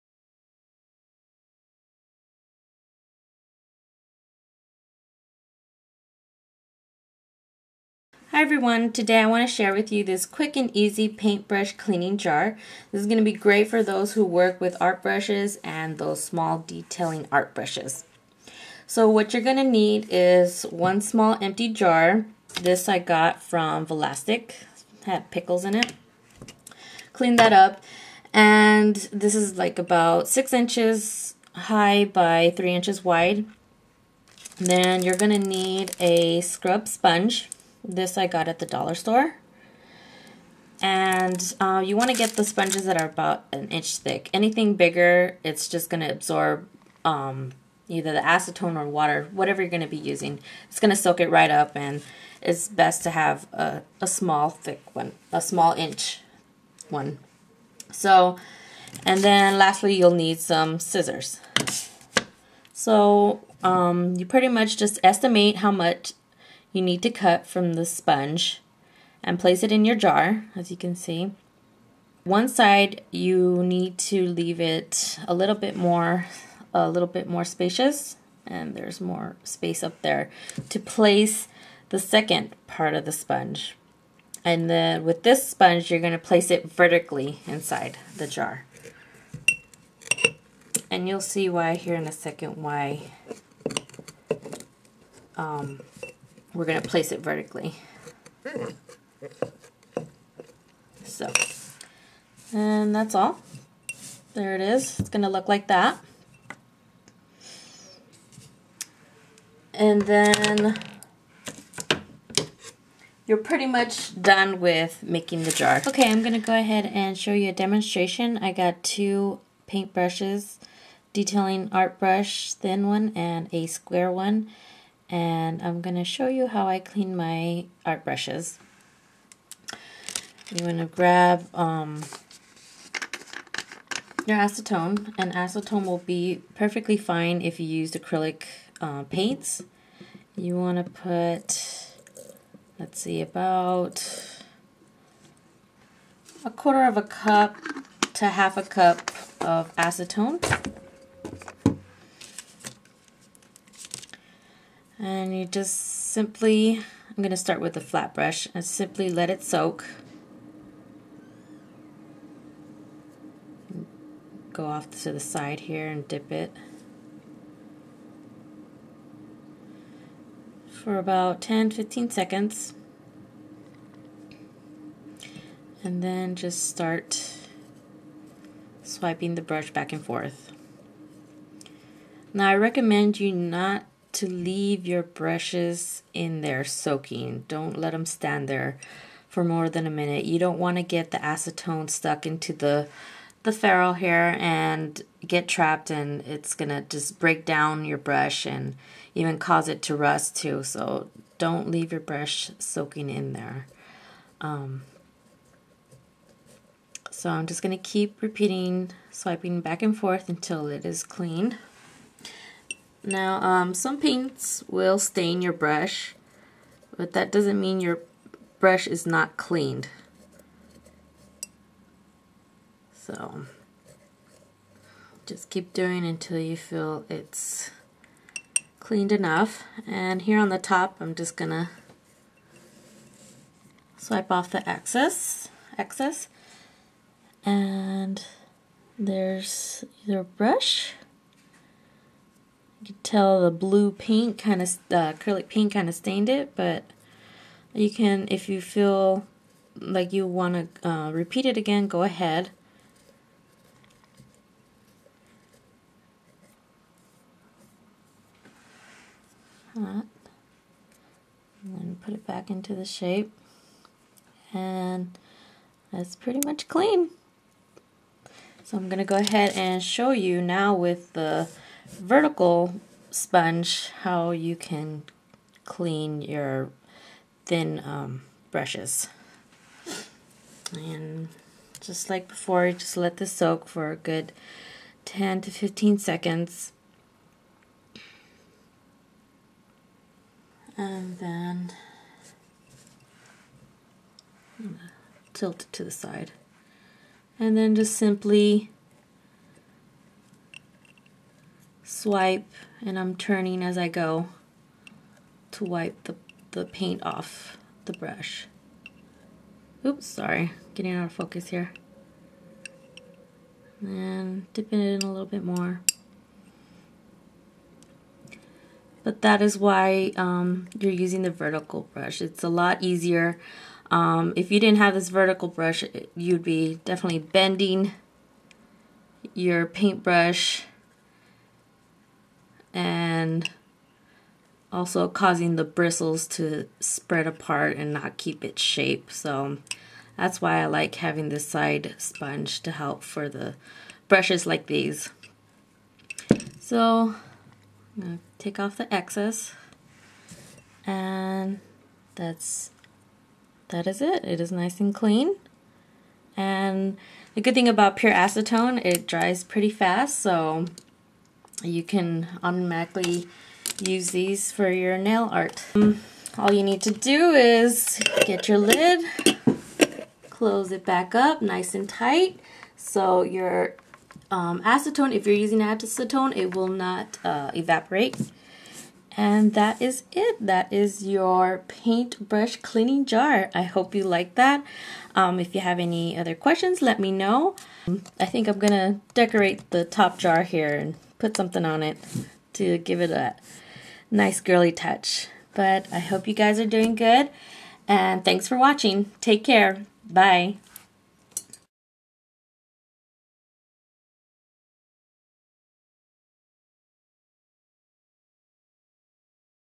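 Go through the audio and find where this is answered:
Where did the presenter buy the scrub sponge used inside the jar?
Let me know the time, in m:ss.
0:38.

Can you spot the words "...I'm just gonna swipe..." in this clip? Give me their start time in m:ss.
3:50.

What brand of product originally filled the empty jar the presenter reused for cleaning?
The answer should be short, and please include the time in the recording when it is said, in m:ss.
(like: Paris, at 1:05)
Vlasic, at 0:23.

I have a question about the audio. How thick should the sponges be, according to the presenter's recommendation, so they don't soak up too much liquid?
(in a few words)
about an inch.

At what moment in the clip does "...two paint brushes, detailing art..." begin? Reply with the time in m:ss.
1:58.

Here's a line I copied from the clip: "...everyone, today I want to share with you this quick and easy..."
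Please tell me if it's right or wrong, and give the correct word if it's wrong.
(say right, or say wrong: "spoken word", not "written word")
right.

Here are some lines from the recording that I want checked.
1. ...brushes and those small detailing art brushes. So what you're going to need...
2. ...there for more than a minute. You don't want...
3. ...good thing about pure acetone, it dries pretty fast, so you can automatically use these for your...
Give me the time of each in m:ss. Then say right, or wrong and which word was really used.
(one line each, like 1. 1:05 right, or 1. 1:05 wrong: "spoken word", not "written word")
1. 0:15 right
2. 3:08 right
3. 5:57 right.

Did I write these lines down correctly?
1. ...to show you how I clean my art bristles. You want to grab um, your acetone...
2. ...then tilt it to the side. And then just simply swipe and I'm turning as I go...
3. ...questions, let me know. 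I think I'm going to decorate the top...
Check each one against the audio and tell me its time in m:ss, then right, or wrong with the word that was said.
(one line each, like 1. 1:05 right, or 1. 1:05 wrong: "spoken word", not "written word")
1. 2:05 wrong: "brushes", not "bristles"
2. 4:51 right
3. 6:26 right.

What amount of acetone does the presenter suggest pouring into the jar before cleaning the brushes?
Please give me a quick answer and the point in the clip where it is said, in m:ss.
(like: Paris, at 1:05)
1/4 to 1/2 cup, at 2:26.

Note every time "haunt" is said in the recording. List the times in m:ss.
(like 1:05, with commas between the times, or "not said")
not said.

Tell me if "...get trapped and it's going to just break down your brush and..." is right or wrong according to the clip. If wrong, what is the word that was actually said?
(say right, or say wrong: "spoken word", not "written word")
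right.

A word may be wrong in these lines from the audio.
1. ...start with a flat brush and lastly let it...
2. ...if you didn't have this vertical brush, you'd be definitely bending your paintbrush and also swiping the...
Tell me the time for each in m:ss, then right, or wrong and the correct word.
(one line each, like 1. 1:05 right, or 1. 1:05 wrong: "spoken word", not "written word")
1. 2:37 wrong: "simply", not "lastly"
2. 5:24 wrong: "causing", not "swiping".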